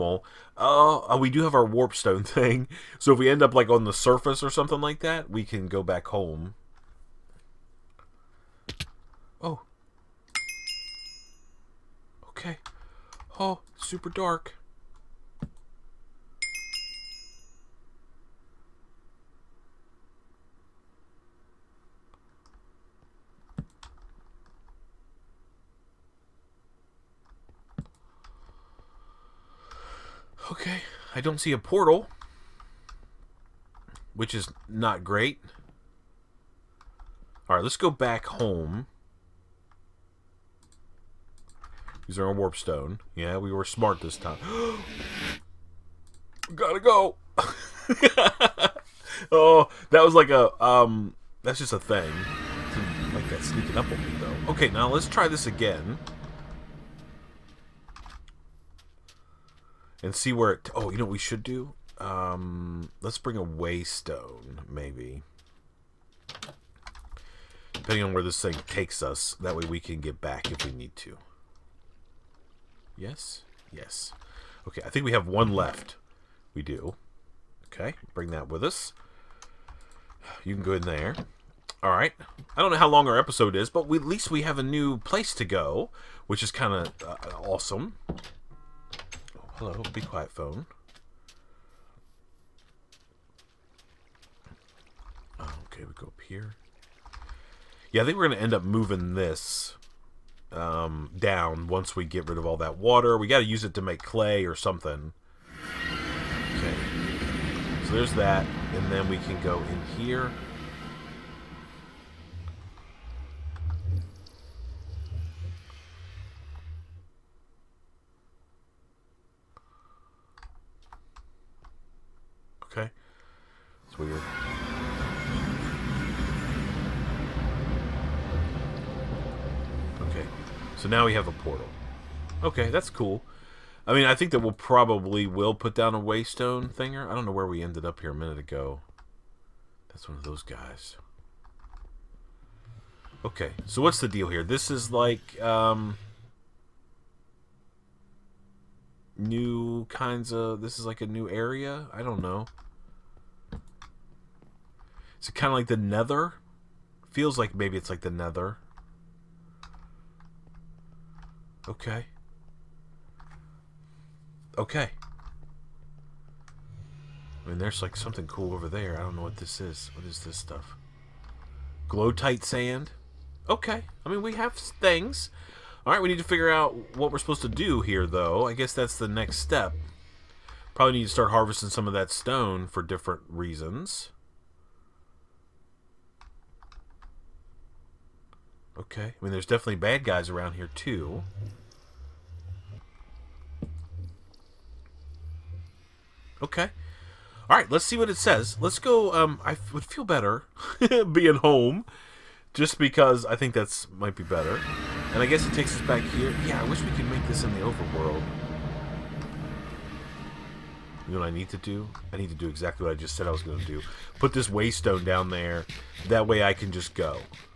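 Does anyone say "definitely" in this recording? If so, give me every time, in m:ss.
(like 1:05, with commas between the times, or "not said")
3:09.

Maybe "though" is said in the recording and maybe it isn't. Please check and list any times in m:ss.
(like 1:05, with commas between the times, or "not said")
0:54, 2:58.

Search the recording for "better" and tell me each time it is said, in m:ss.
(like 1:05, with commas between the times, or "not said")
3:20, 3:24.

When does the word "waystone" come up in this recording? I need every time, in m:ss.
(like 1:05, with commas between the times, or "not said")
1:03, 2:16, 3:34.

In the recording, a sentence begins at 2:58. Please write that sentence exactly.
I guess that's the next step.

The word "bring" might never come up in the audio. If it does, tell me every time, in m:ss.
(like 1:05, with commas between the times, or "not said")
1:03, 1:18.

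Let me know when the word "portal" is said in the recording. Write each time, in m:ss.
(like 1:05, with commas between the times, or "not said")
0:31, 2:11.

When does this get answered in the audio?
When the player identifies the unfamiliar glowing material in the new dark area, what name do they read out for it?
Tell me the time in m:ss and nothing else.
2:51.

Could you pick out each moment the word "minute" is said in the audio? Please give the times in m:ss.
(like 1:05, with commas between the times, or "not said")
2:18.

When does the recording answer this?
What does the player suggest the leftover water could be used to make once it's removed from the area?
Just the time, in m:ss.
1:44.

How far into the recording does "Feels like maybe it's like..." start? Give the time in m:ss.
2:37.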